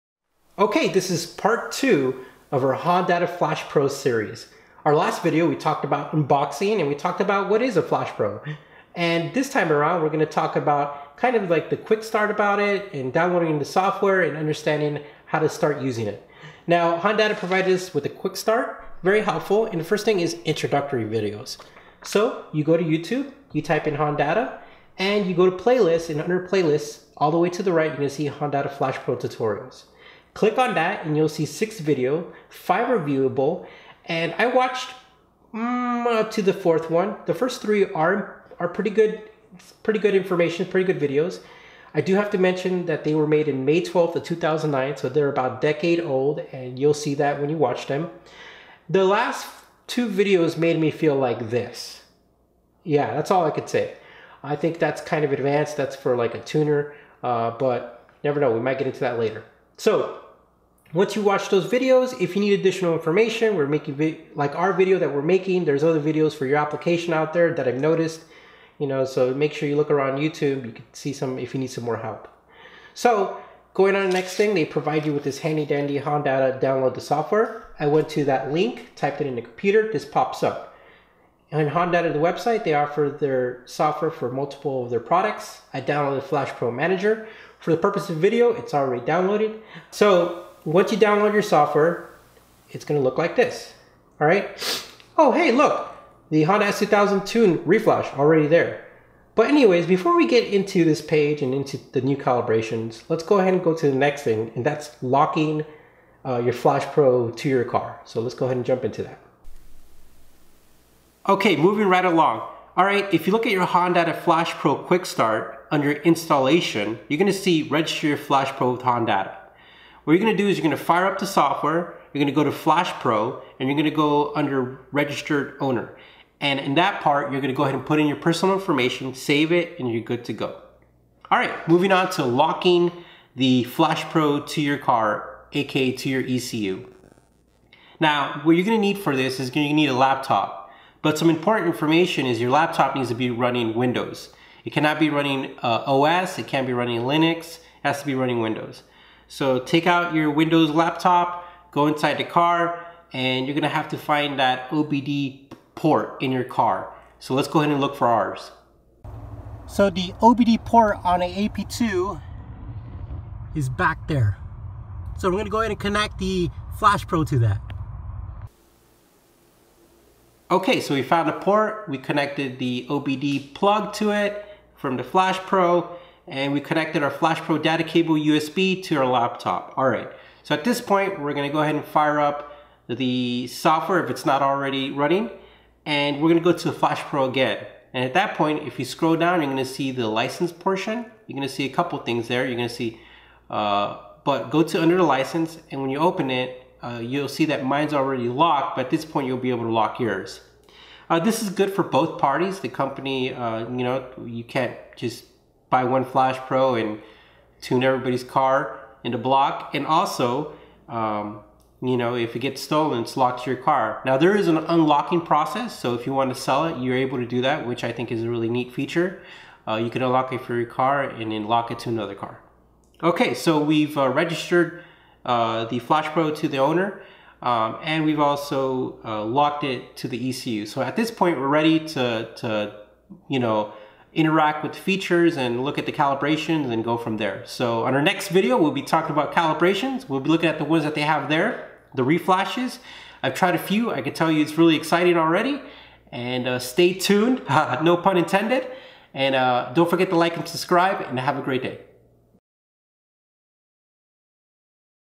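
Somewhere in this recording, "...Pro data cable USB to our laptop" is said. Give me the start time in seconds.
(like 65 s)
177 s.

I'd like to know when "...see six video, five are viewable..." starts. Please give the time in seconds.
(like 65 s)
31 s.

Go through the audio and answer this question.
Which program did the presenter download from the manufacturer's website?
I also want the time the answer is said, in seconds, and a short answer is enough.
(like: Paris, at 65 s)
Flash Pro Manager, at 86 s.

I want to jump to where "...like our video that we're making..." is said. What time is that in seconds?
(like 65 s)
64 s.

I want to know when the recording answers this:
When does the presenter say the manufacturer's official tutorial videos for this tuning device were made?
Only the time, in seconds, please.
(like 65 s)
43 s.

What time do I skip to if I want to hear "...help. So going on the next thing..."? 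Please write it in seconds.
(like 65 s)
71 s.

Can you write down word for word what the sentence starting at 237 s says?
So on our next video, we'll be talking about calibrations.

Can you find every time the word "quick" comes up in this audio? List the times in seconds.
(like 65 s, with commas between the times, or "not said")
11 s, 18 s, 114 s.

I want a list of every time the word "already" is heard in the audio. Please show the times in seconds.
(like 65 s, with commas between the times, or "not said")
88 s, 98 s, 184 s, 197 s, 245 s.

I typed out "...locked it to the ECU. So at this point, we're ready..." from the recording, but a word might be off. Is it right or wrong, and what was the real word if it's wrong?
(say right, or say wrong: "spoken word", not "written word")
right.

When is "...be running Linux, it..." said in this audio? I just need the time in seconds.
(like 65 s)
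146 s.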